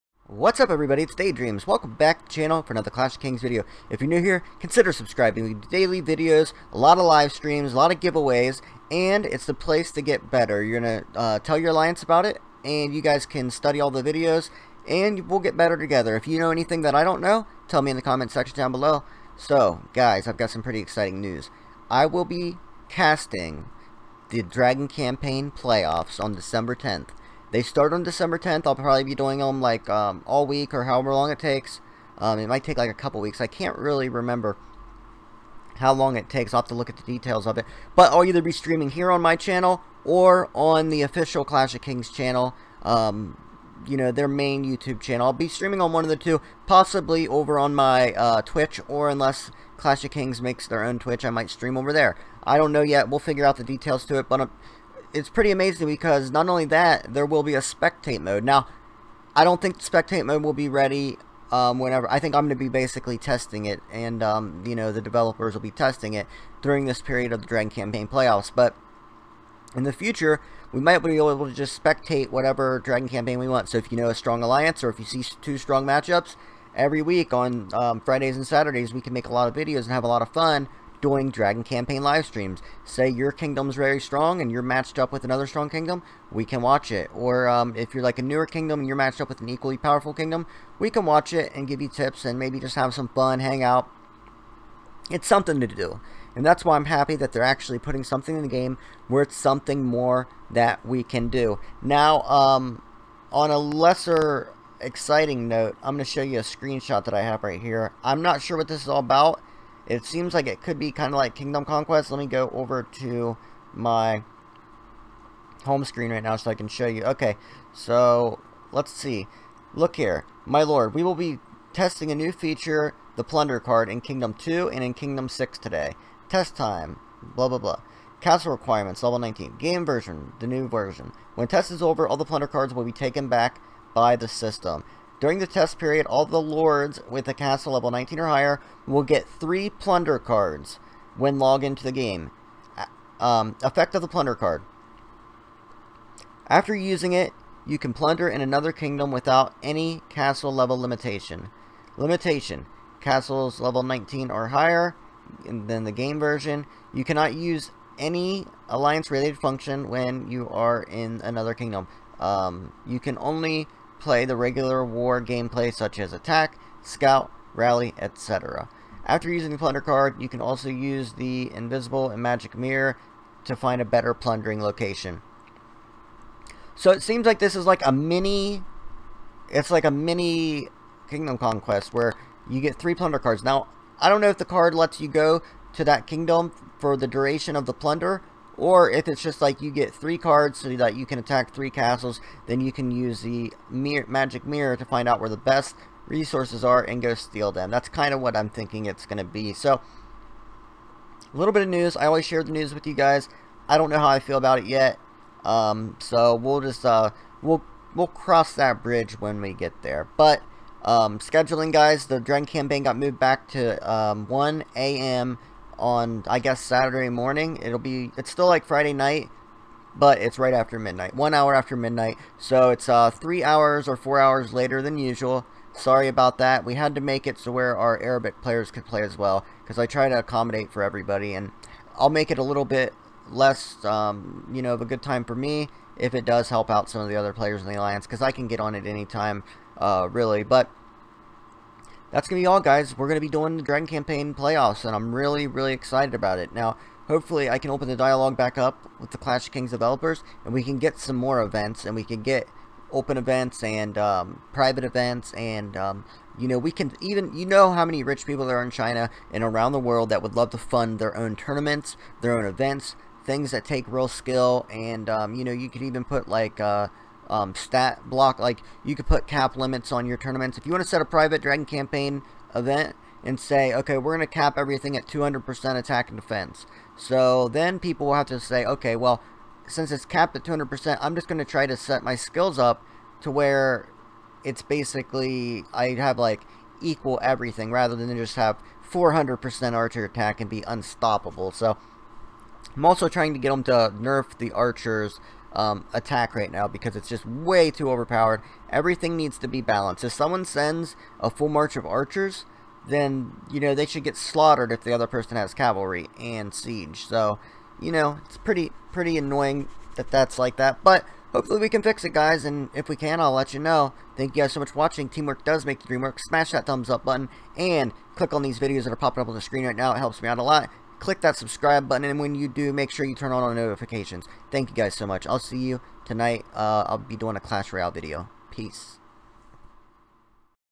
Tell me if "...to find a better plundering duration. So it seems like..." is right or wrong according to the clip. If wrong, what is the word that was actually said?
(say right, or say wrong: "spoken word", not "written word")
wrong: "location", not "duration".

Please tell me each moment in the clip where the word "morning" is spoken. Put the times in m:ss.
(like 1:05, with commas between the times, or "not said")
3:37.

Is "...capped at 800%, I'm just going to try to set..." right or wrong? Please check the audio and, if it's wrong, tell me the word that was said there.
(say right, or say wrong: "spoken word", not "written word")
wrong: "200", not "800".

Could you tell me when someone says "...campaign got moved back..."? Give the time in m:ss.
3:32.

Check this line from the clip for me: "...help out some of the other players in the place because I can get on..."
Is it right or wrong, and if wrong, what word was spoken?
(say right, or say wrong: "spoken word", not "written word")
wrong: "alliance", not "place".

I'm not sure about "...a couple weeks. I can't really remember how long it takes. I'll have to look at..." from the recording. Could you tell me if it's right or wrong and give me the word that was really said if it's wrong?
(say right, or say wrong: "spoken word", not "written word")
right.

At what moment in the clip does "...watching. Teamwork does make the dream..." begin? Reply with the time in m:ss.
5:14.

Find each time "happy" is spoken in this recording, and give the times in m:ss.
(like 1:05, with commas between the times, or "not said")
1:36.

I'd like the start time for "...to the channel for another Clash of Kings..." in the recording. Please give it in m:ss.
0:02.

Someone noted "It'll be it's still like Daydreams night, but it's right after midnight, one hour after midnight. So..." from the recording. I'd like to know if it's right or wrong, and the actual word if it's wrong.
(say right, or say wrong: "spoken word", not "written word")
wrong: "Friday", not "Daydreams".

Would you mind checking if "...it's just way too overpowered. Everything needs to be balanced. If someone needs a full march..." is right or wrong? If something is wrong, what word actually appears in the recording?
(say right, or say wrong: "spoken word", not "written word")
wrong: "sends", not "needs".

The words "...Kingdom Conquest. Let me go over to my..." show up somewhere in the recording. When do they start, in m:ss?
1:51.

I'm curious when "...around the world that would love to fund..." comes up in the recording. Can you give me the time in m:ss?
4:19.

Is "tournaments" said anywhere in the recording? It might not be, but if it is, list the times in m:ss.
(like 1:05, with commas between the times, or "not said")
4:21, 4:30.